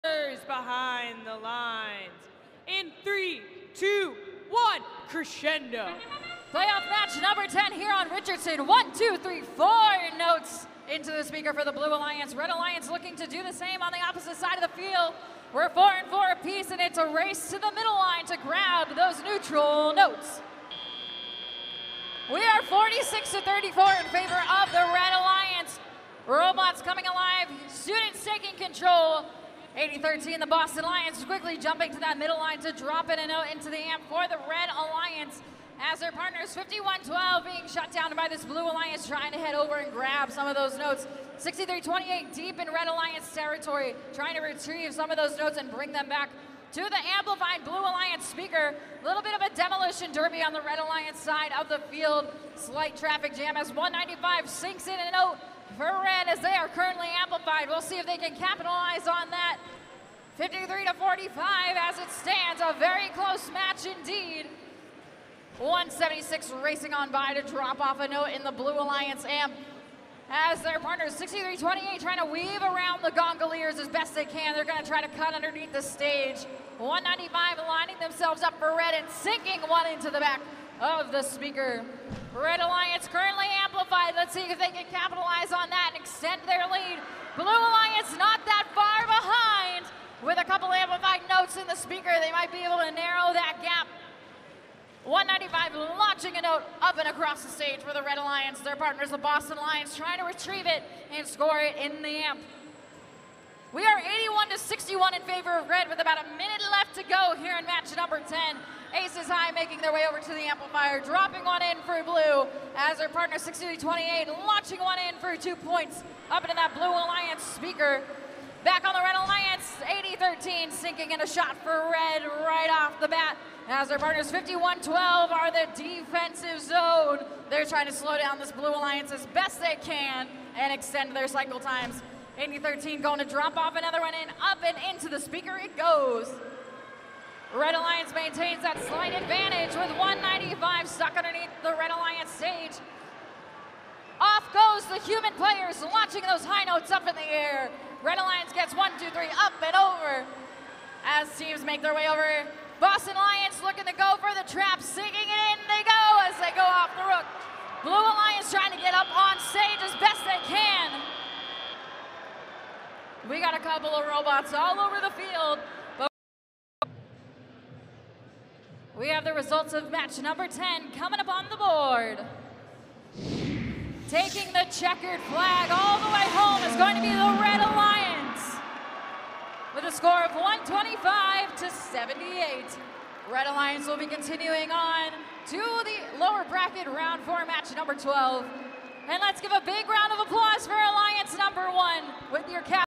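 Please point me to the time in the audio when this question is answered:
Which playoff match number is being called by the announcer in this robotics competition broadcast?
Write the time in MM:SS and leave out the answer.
00:06.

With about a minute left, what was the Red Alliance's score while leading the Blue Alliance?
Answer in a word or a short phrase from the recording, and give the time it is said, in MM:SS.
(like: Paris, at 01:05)
81, at 01:43.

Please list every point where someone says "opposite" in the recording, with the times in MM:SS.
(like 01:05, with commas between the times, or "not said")
00:14.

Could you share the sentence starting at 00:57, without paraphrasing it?
We'll see if they can capitalize on that.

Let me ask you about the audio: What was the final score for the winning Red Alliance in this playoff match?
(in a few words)
125.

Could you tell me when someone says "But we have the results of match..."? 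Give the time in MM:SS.
02:45.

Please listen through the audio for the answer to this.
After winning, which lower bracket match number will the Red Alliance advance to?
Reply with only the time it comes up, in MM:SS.
03:07.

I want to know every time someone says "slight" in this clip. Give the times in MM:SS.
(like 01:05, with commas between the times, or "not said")
00:52, 02:18.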